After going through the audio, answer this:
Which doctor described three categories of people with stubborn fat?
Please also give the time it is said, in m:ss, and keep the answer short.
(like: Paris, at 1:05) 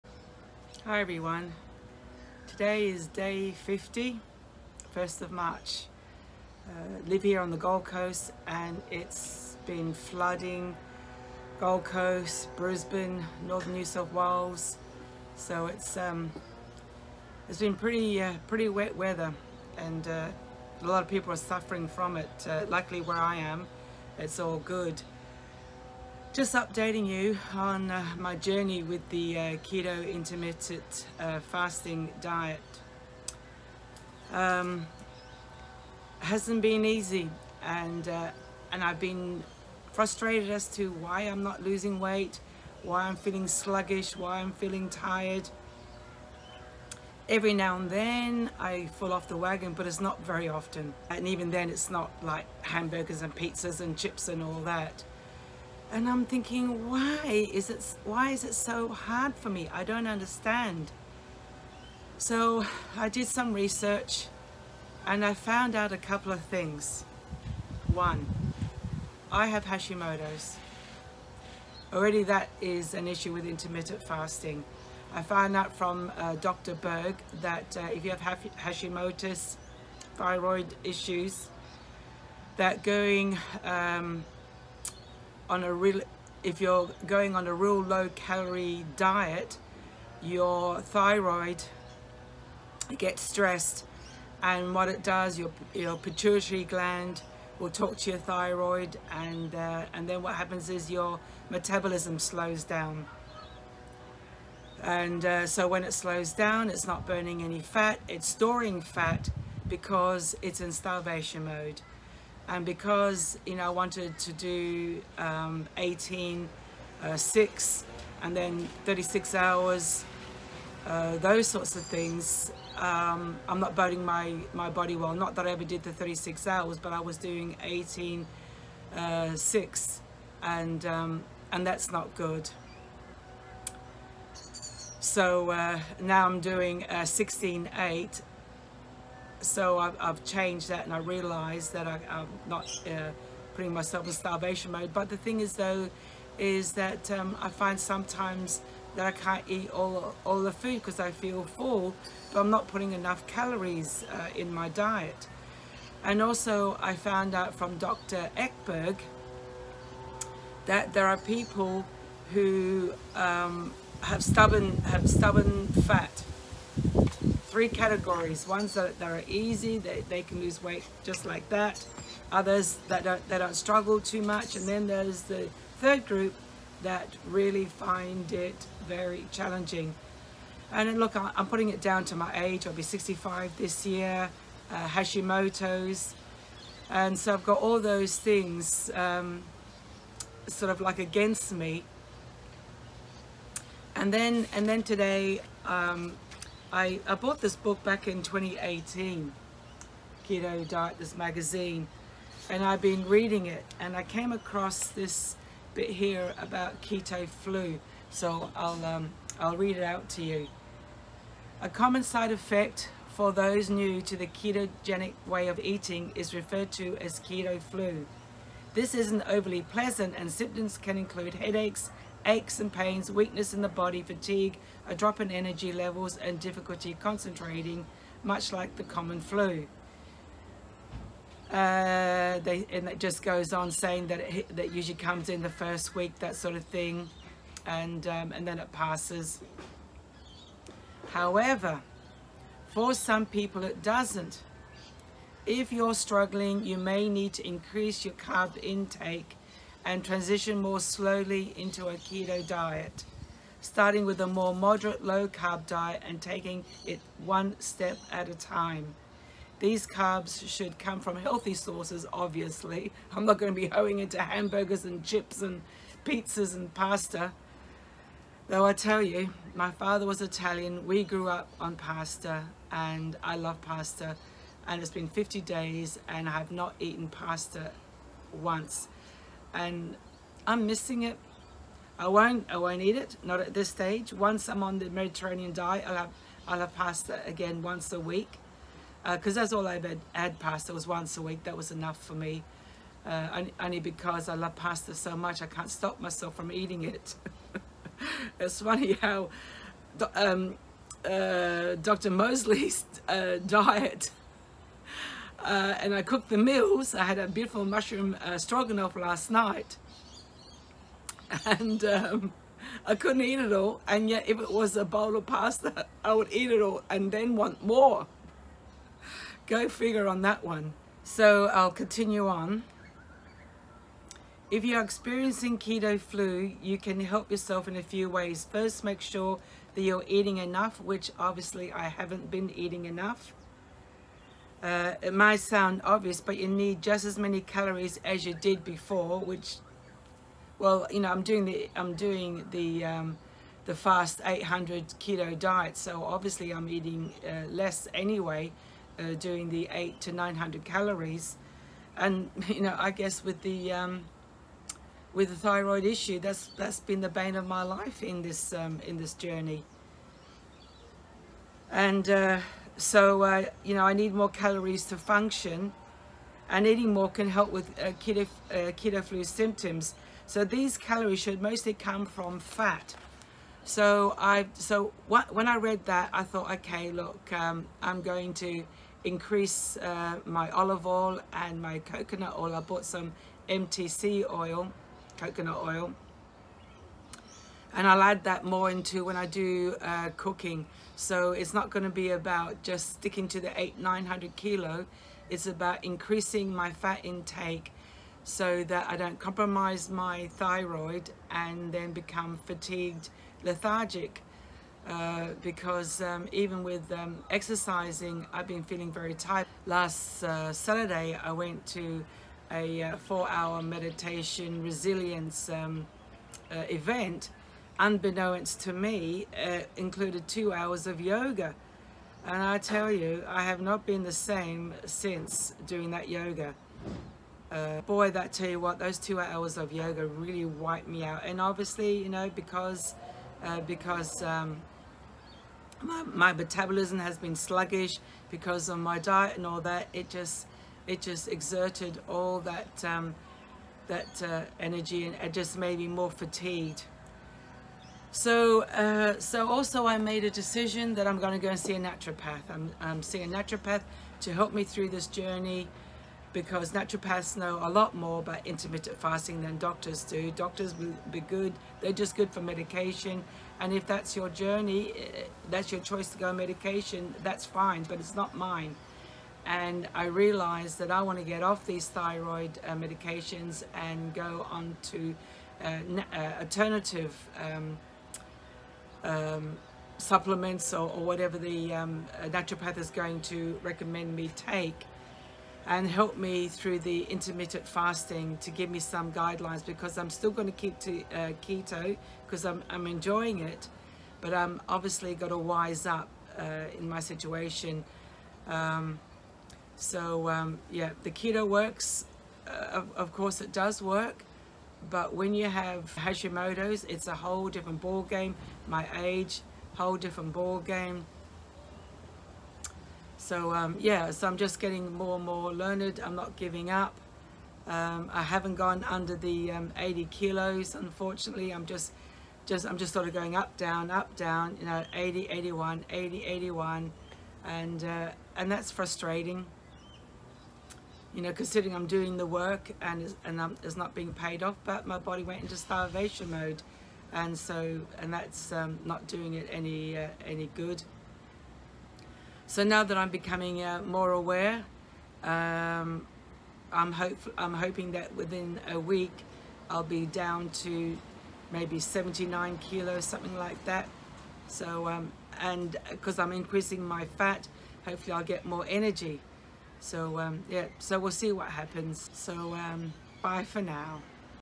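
Dr. Ekberg, at 2:37.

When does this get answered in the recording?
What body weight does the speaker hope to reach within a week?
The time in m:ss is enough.
9:11.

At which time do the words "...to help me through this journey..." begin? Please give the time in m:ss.
7:34.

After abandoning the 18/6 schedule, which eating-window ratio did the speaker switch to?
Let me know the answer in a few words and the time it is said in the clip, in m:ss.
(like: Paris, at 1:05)
16:8, at 2:17.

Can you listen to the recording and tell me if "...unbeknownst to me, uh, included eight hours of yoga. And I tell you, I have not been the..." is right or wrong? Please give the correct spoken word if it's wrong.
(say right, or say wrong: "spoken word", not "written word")
wrong: "two", not "eight".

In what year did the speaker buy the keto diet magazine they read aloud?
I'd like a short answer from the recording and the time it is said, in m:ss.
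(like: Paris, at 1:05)
2018, at 3:18.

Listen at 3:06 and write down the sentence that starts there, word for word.
And so I've got all those things um, sort of like against me.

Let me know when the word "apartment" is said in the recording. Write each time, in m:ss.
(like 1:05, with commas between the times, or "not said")
not said.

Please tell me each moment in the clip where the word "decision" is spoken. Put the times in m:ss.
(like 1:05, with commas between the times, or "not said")
7:30.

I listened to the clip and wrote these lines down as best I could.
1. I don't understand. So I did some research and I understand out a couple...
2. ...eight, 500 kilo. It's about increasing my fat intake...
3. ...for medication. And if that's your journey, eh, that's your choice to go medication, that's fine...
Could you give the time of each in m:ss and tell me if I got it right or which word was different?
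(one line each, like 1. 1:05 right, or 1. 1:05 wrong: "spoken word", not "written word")
1. 0:59 wrong: "found", not "understand"
2. 6:33 wrong: "900", not "500"
3. 7:42 right.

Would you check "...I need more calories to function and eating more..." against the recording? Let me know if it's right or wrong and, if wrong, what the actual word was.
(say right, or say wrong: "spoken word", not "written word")
right.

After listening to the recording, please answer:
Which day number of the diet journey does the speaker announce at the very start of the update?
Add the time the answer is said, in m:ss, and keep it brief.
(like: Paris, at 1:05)
50, at 0:03.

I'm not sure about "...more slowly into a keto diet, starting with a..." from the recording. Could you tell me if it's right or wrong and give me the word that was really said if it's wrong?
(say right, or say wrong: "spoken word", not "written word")
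right.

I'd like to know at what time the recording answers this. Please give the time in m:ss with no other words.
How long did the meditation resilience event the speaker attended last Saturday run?
6:52.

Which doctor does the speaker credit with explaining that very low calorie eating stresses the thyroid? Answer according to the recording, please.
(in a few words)
Dr. Berg.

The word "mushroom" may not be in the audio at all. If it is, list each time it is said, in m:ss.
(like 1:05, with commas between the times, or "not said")
5:07.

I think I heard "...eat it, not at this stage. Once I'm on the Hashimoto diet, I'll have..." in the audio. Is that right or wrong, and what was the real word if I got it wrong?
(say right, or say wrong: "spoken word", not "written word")
wrong: "Mediterranean", not "Hashimoto".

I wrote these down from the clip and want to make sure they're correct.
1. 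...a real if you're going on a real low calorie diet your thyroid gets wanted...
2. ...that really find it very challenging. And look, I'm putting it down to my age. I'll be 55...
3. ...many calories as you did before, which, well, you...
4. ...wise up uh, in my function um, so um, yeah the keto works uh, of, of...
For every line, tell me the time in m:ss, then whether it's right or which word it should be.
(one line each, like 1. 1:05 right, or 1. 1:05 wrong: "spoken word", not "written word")
1. 1:25 wrong: "stressed", not "wanted"
2. 2:56 wrong: "65", not "55"
3. 5:37 right
4. 8:15 wrong: "situation", not "function".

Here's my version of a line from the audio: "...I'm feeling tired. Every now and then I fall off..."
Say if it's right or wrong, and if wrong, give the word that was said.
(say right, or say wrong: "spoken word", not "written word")
right.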